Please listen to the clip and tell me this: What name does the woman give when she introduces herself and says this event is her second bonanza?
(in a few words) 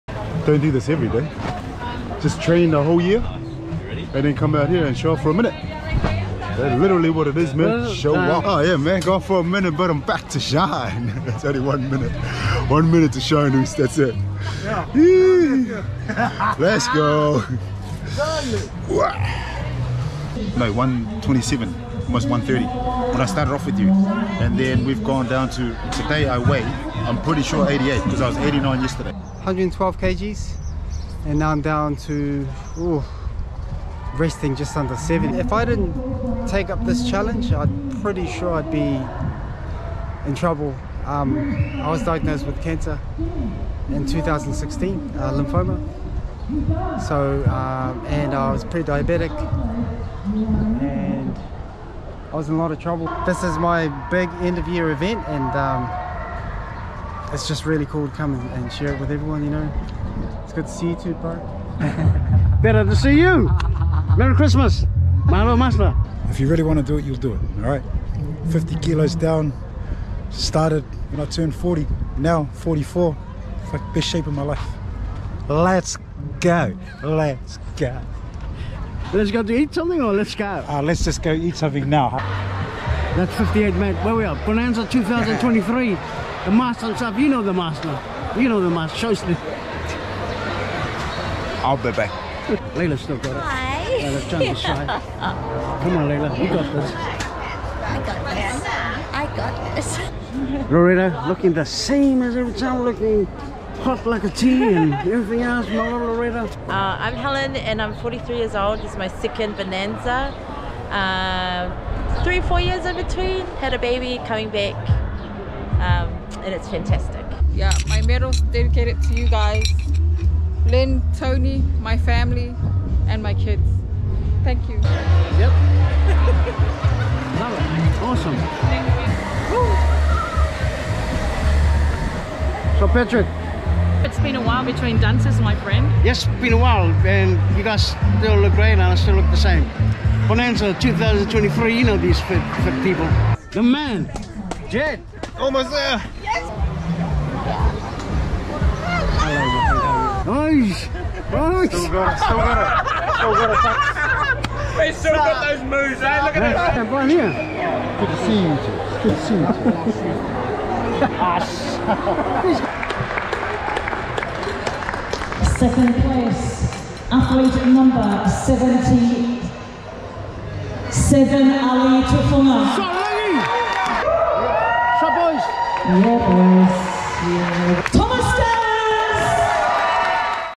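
Helen.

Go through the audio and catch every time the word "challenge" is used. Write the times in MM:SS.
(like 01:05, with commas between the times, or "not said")
00:37.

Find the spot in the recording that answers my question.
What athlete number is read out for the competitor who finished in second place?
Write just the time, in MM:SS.
02:48.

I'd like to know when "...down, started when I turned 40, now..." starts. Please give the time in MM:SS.
01:09.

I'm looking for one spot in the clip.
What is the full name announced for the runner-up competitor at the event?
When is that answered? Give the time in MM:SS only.
02:51.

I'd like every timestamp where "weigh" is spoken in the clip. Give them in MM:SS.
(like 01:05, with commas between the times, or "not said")
00:26.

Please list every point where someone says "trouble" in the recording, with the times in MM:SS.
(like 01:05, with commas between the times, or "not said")
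00:40, 00:52.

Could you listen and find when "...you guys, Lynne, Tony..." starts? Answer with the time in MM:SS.
01:59.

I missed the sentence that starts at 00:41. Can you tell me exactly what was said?
Um, I was diagnosed with cancer in 2016, uh, lymphoma.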